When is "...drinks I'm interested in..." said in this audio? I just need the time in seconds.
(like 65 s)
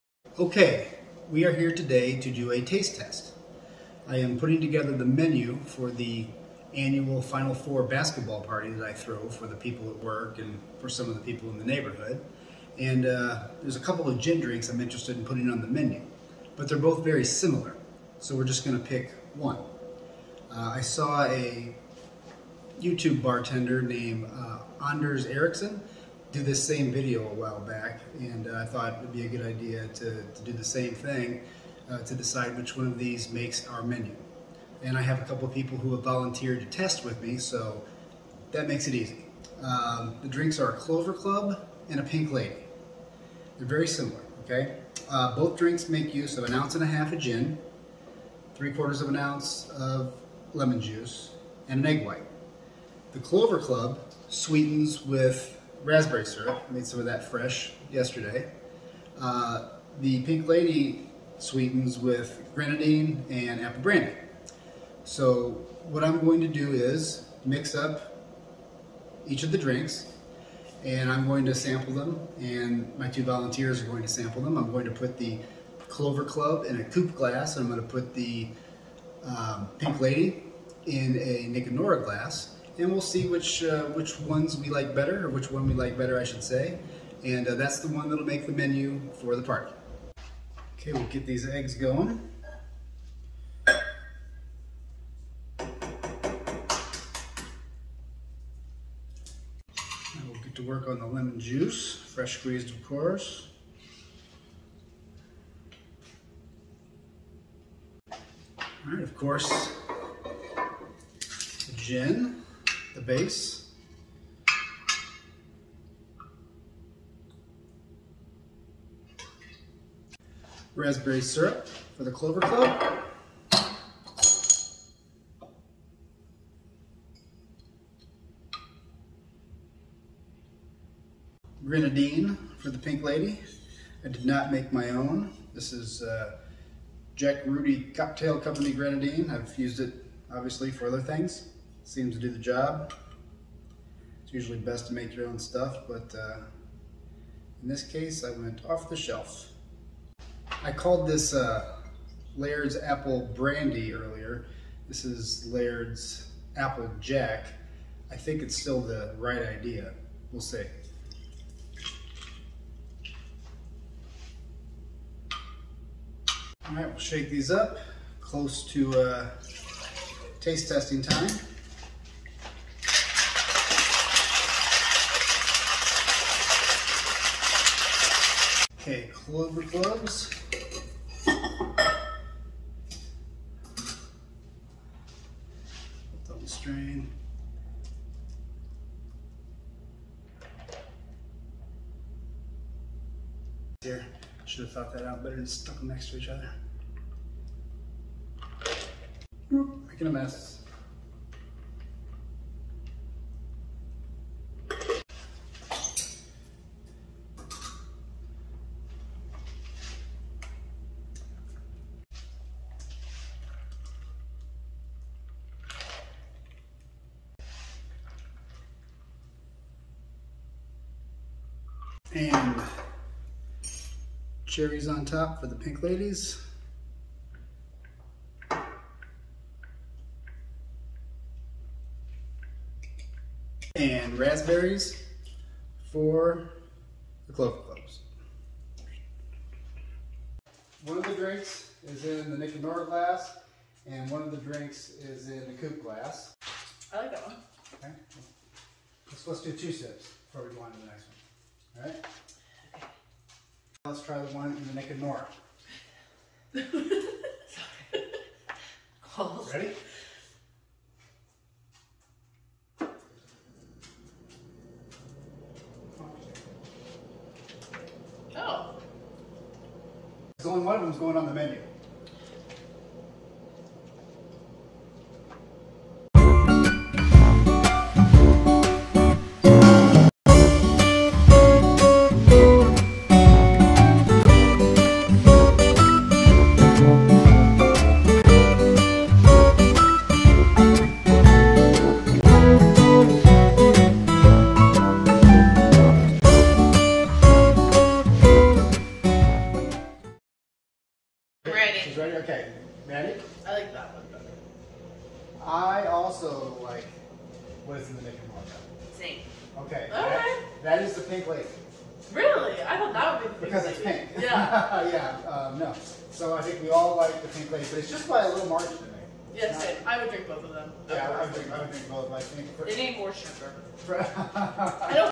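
14 s.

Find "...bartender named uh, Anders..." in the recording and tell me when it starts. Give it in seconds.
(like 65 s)
23 s.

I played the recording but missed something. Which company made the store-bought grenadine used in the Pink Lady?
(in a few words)
Jack Rudy Cocktail Company.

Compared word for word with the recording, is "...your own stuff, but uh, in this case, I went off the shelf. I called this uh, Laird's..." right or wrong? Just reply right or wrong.
right.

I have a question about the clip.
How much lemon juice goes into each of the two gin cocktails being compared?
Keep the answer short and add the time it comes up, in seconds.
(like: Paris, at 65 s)
3/4 ounce, at 48 s.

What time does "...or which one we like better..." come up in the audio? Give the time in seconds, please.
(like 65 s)
85 s.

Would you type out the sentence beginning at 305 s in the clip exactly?
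I also like what is in the Mickey Mouse.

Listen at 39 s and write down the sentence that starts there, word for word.
Um, the drinks are a Clover Club and a Pink Lady.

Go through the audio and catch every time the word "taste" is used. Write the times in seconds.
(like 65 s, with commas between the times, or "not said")
2 s, 170 s.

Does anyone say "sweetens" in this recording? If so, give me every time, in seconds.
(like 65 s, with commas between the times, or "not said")
54 s, 61 s.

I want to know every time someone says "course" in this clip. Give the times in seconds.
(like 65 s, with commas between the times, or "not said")
102 s, 109 s.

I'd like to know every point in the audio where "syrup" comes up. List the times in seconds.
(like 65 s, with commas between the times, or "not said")
56 s, 121 s.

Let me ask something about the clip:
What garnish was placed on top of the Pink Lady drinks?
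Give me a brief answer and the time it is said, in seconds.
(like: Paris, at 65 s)
cherries, at 224 s.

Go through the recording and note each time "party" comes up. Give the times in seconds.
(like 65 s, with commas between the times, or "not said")
8 s, 89 s.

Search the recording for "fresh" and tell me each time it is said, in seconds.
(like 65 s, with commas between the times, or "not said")
57 s, 101 s.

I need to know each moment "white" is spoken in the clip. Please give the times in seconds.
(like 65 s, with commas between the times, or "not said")
52 s.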